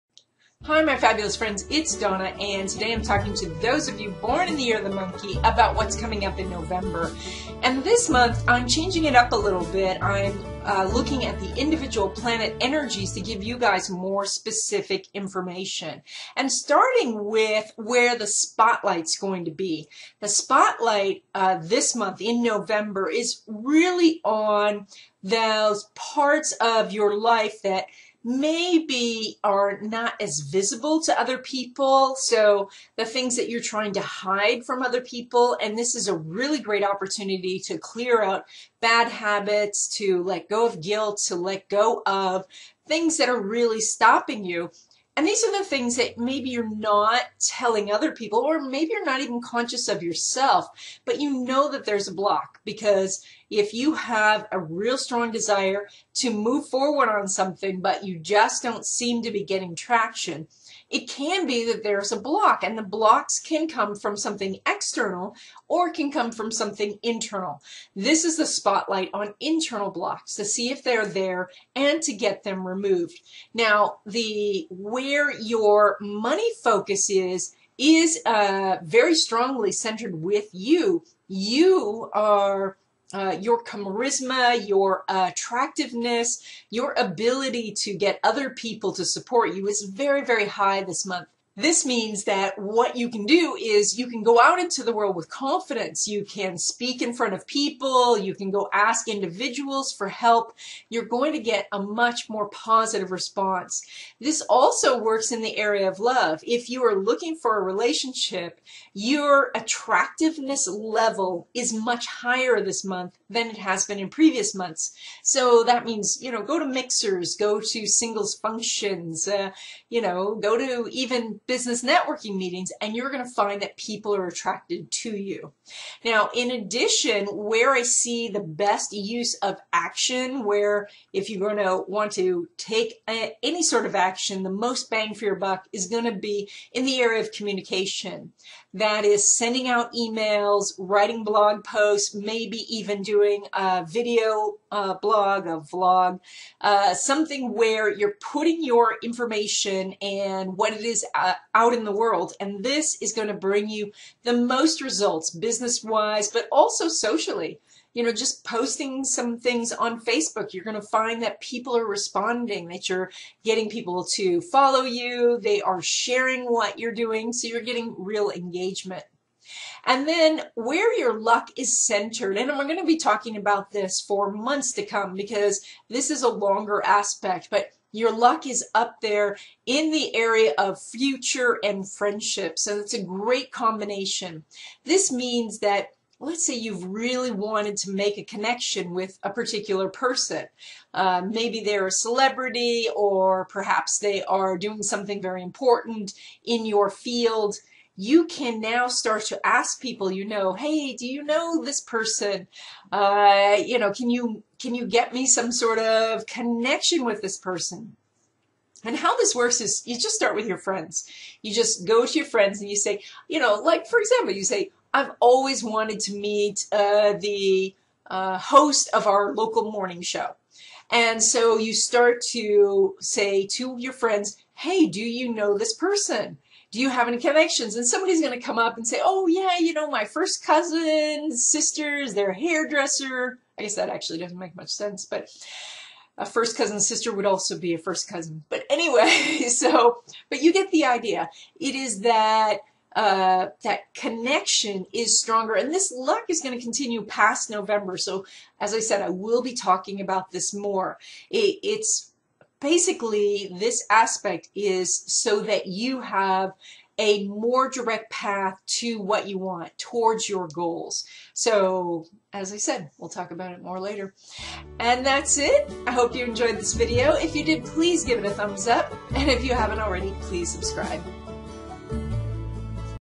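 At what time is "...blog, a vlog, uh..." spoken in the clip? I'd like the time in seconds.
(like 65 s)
144 s.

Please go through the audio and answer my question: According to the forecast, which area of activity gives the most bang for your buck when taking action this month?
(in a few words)
Communication.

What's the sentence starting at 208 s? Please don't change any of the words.
And how this works is you just start with your friends.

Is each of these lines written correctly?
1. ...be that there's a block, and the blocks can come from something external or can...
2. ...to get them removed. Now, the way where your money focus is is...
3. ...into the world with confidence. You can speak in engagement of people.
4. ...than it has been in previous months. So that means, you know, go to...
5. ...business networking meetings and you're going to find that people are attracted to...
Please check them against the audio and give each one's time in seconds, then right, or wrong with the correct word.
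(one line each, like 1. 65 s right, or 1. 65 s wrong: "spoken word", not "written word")
1. 61 s right
2. 72 s right
3. 94 s wrong: "front", not "engagement"
4. 113 s right
5. 121 s right.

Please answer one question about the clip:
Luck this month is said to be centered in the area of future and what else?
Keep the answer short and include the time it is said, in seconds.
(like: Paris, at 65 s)
Friendship, at 181 s.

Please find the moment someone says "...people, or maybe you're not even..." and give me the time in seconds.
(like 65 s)
48 s.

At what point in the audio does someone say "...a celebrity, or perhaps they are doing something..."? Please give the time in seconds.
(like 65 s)
191 s.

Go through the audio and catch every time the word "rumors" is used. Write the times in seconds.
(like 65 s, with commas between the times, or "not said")
not said.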